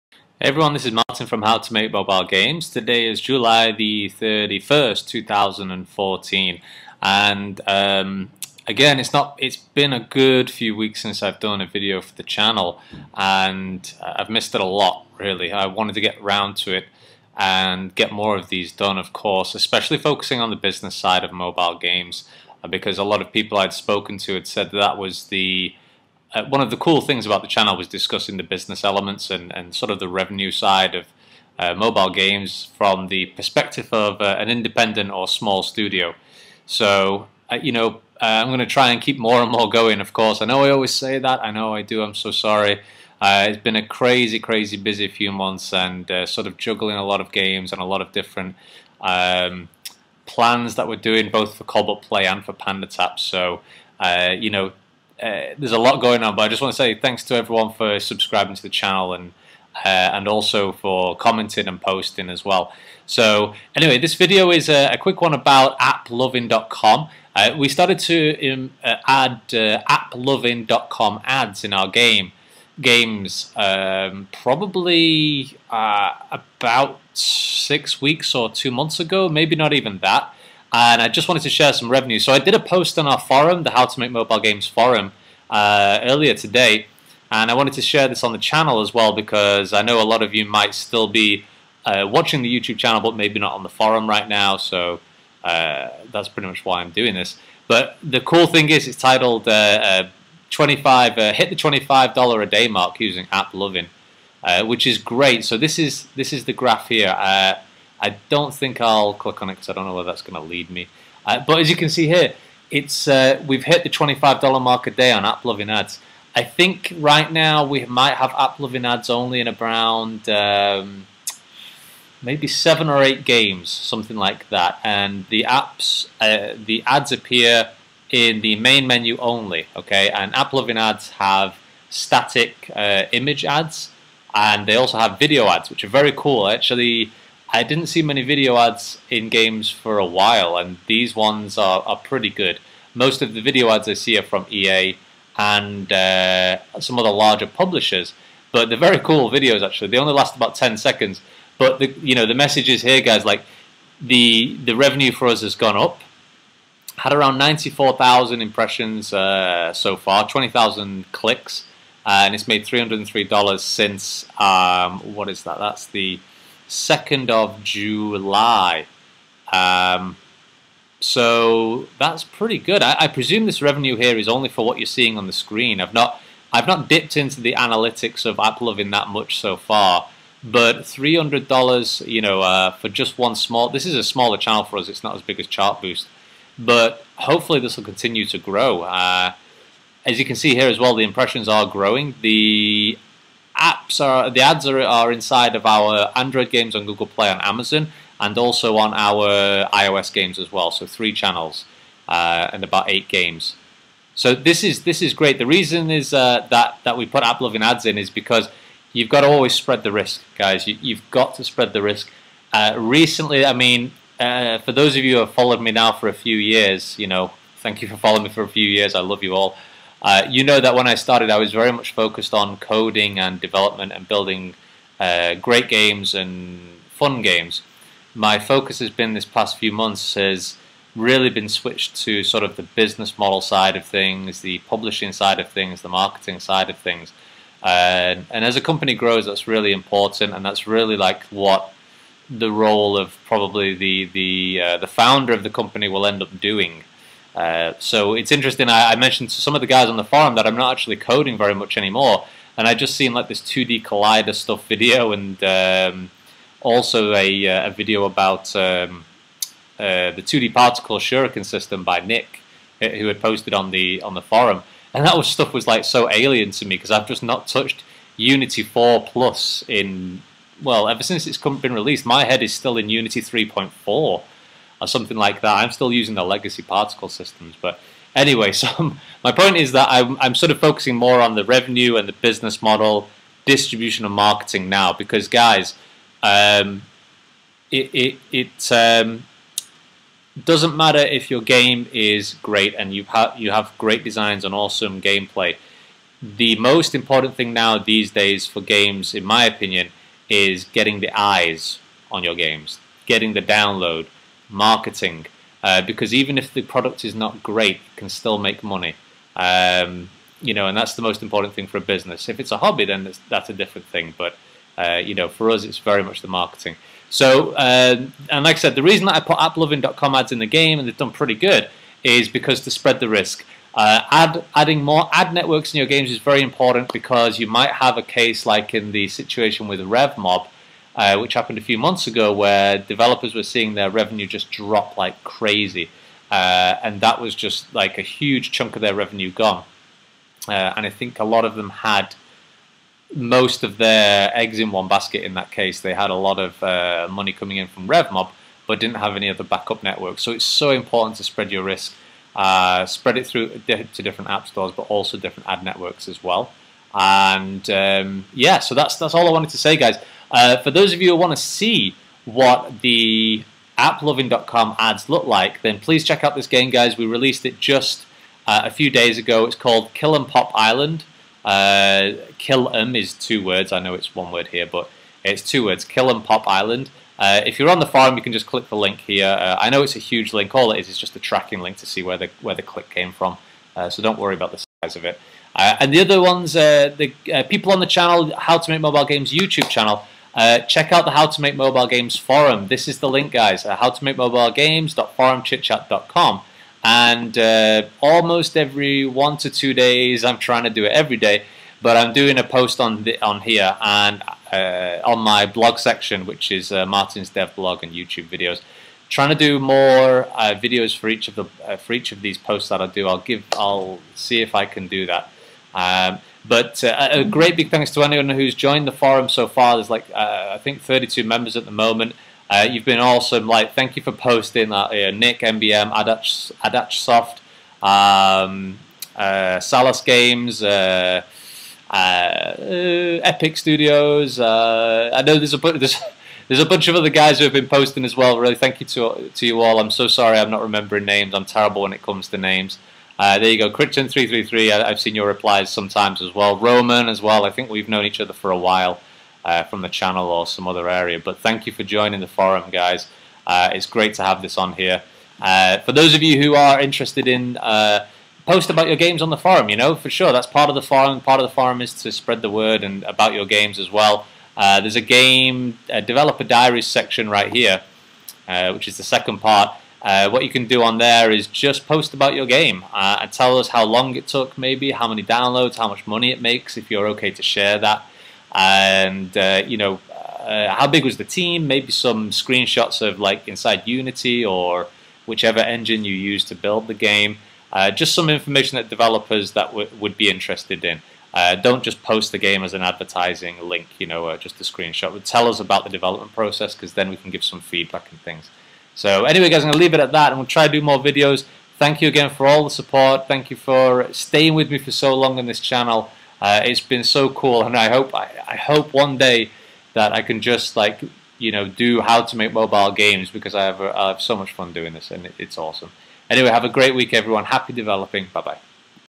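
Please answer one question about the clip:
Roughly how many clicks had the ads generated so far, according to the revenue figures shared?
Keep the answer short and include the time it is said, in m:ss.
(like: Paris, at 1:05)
20,000, at 2:40.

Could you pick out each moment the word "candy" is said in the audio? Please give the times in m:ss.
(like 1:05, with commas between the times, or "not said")
not said.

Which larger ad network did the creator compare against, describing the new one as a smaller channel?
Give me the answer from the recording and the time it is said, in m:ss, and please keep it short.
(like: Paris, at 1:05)
Chartboost, at 3:05.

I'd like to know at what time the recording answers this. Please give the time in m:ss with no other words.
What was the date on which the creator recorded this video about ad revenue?
0:03.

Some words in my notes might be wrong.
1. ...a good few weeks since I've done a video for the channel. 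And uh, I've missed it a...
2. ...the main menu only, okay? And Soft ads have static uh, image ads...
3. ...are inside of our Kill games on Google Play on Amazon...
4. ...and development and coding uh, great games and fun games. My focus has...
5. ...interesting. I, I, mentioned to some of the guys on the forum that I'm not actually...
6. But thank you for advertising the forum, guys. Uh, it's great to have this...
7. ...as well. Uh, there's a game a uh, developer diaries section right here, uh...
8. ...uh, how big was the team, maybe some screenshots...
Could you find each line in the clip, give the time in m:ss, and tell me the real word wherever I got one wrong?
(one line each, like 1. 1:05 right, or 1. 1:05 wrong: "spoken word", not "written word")
1. 0:09 right
2. 2:08 wrong: "AppLovin", not "Soft"
3. 3:14 wrong: "Android", not "Kill"
4. 3:43 wrong: "building", not "coding"
5. 4:08 right
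6. 7:31 wrong: "joining", not "advertising"
7. 7:43 right
8. 8:00 right.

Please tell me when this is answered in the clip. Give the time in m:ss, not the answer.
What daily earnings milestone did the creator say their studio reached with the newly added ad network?
1:53.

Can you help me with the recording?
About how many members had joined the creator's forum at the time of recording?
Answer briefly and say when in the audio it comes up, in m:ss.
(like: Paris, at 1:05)
32, at 7:00.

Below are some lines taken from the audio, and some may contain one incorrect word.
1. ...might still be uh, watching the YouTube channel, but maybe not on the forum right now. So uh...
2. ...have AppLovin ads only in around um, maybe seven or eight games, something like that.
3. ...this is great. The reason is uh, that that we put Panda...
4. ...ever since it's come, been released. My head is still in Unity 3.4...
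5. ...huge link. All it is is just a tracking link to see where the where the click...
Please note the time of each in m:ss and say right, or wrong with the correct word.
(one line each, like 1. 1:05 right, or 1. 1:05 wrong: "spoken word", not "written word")
1. 1:30 right
2. 1:58 right
3. 3:24 wrong: "AppLovin", not "Panda"
4. 4:30 right
5. 6:19 right.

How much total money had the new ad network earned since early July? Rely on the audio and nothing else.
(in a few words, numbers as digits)
$303.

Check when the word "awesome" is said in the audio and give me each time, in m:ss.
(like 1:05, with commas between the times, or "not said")
4:54, 7:02, 8:35.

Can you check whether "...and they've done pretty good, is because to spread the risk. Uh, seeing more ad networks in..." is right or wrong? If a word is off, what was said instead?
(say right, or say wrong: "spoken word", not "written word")
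wrong: "adding", not "seeing".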